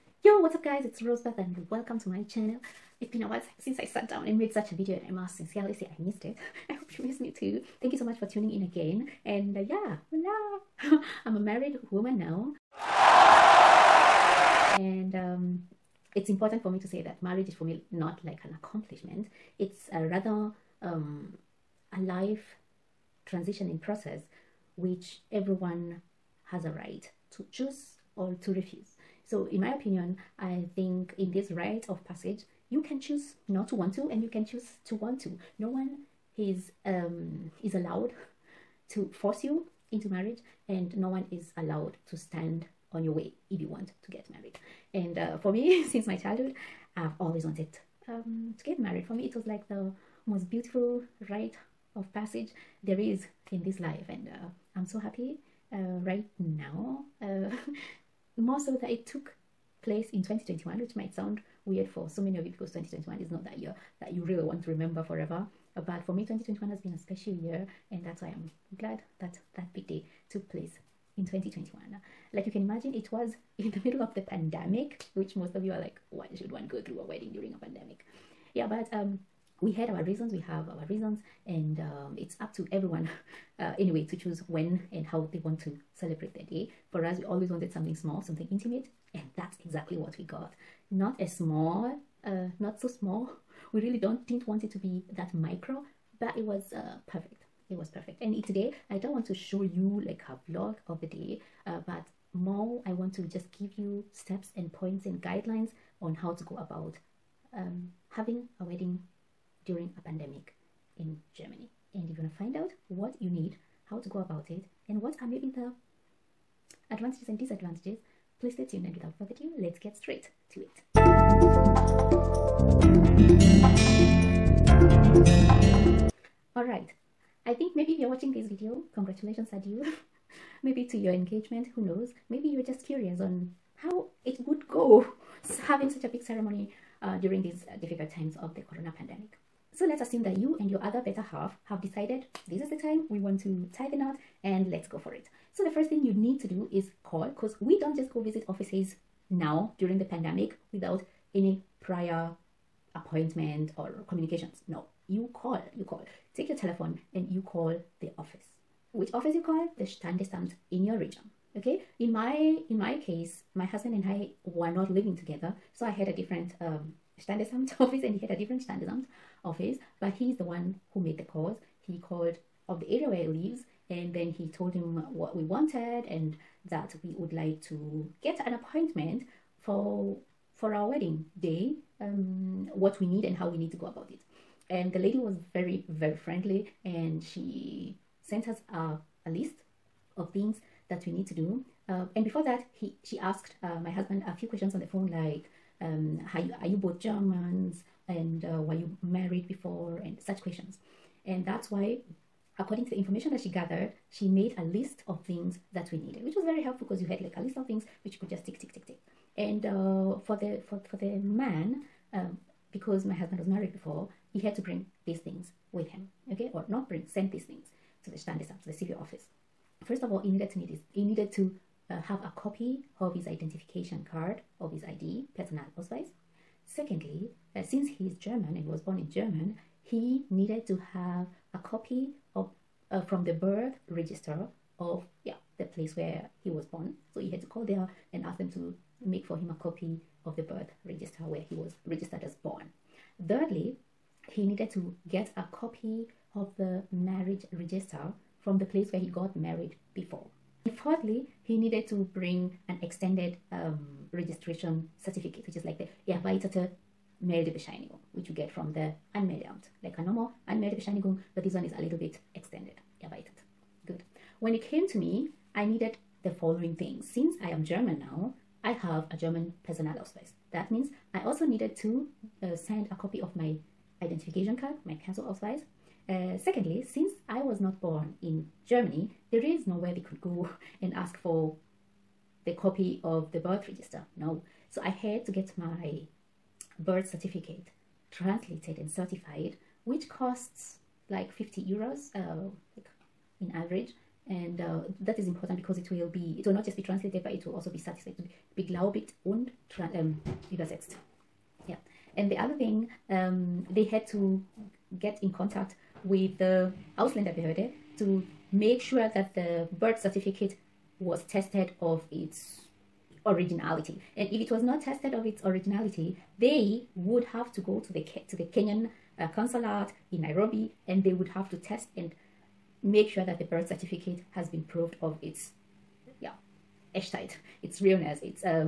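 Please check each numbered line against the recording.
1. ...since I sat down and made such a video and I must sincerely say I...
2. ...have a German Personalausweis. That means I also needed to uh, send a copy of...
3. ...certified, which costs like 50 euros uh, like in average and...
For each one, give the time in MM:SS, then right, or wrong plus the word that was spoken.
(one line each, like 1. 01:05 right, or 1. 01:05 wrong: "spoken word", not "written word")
1. 00:03 right
2. 04:28 right
3. 04:48 right.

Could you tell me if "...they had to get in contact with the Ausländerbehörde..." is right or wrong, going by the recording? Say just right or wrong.
right.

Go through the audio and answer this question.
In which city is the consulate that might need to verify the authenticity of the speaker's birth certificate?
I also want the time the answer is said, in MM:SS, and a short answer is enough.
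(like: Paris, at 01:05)
Nairobi, at 05:20.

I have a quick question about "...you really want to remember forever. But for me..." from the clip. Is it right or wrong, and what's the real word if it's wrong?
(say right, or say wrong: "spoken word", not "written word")
right.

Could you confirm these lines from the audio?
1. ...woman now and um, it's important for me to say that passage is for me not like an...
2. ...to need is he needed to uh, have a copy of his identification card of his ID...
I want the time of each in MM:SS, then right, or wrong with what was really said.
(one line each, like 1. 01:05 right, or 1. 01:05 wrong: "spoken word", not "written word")
1. 00:11 wrong: "marriage", not "passage"
2. 03:40 right.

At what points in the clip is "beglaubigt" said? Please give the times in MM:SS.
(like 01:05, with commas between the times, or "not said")
04:58.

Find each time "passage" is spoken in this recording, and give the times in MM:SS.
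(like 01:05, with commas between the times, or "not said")
00:32, 00:52.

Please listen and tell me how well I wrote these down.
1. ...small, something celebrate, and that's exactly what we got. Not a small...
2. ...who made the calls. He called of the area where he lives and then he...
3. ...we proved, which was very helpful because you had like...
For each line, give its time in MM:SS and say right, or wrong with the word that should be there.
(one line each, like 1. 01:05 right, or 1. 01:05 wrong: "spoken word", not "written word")
1. 01:27 wrong: "intimate", not "celebrate"
2. 02:50 right
3. 03:25 wrong: "needed", not "proved".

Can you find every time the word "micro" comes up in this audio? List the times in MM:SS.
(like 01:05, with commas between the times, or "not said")
01:35.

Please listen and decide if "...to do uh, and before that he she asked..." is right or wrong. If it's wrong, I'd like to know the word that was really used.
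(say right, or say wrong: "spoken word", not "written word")
right.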